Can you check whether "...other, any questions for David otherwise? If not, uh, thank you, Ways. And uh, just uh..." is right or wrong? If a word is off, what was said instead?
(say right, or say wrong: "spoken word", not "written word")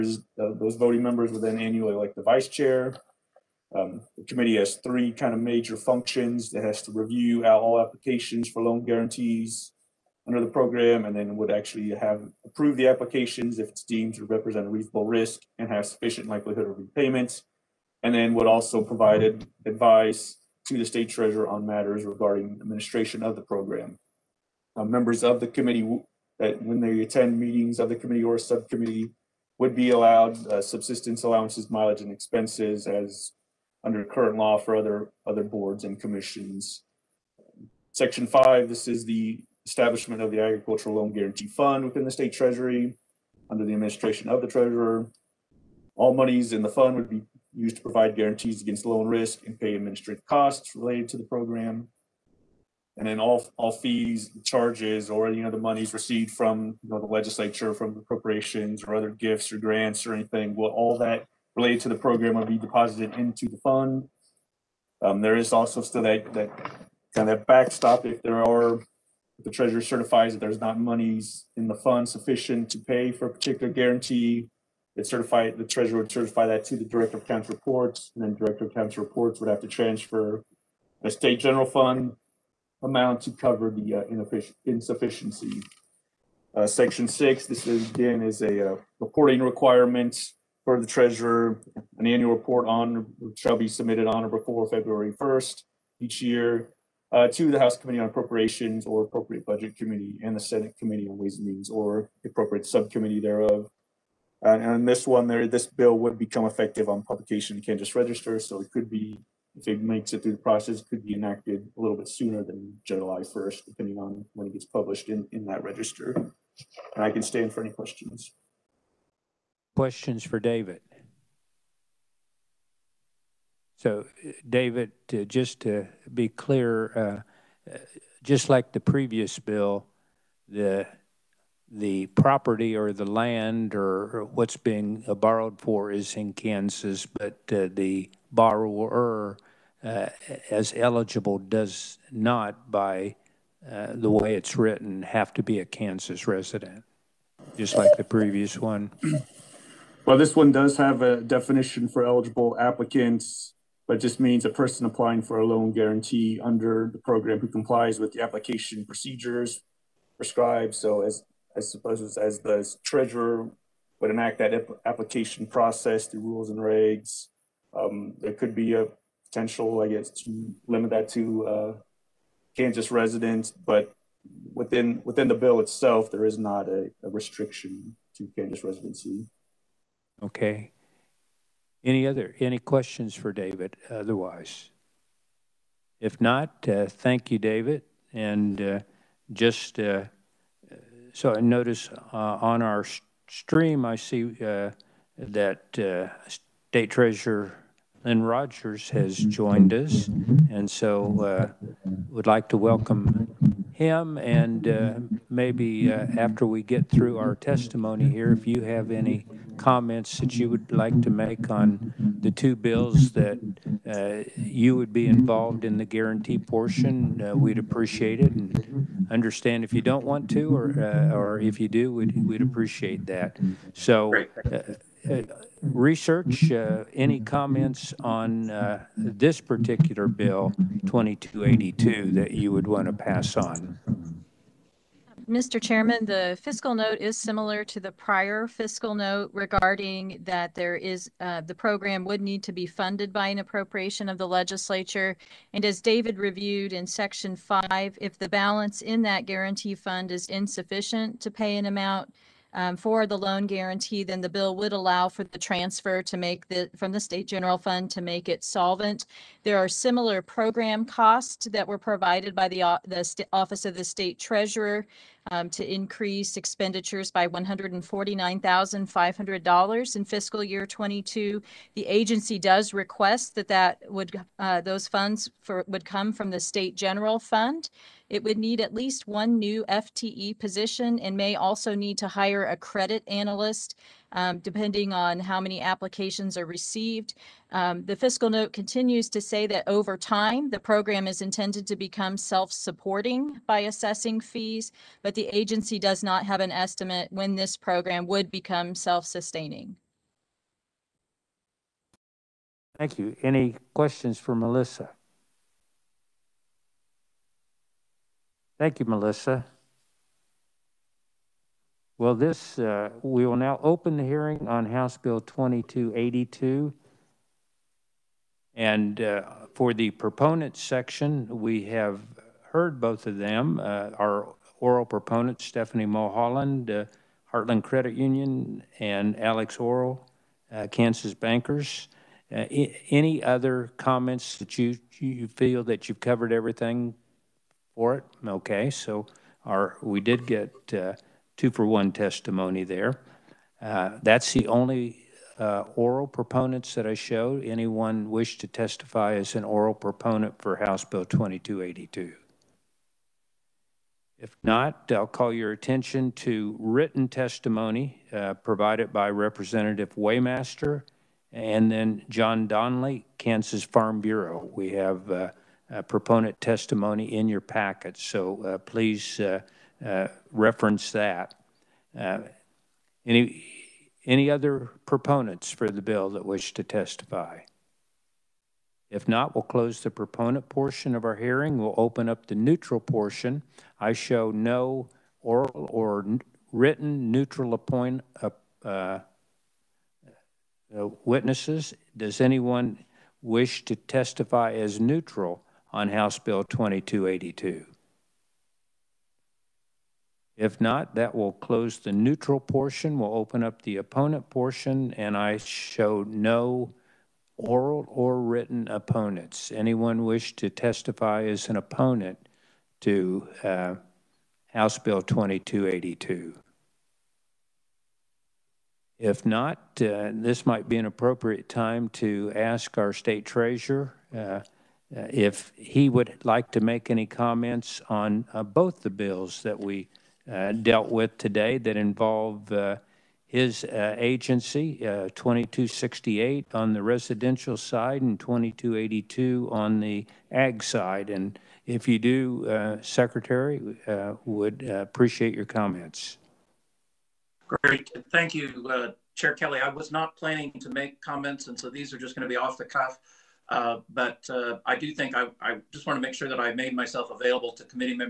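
wrong: "David", not "Ways".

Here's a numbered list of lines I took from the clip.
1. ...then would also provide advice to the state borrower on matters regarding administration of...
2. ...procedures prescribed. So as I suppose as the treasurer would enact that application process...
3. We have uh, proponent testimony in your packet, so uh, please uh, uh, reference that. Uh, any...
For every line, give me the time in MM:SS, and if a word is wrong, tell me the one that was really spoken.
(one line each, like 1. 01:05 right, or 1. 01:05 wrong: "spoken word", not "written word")
1. 00:18 wrong: "treasurer", not "borrower"
2. 02:38 right
3. 06:04 right.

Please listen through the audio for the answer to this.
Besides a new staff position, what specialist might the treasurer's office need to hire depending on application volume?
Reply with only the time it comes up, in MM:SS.
04:42.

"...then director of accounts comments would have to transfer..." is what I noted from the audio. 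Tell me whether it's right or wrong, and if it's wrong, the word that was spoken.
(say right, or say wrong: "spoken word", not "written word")
wrong: "reports", not "comments".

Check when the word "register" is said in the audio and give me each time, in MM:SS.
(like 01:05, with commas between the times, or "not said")
01:47, 01:55.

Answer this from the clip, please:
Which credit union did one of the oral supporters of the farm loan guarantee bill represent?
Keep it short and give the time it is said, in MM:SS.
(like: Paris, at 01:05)
Heartland Credit Union, at 05:27.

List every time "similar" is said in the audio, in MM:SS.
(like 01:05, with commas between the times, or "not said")
03:57, 04:19.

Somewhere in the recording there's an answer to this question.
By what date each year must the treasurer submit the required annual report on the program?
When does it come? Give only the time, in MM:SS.
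01:34.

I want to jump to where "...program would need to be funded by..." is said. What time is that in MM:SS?
04:01.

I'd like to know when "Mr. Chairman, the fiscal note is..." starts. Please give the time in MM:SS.
03:55.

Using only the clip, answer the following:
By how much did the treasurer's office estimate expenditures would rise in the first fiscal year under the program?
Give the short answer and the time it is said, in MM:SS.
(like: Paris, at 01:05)
$149,500, at 04:27.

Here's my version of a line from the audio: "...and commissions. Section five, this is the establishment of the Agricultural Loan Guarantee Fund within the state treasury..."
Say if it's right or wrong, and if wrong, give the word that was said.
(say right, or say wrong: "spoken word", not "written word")
right.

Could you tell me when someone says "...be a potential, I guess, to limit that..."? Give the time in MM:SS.
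02:48.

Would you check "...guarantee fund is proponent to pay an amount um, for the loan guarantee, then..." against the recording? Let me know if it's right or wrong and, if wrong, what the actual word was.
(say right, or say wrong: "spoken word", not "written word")
wrong: "insufficient", not "proponent".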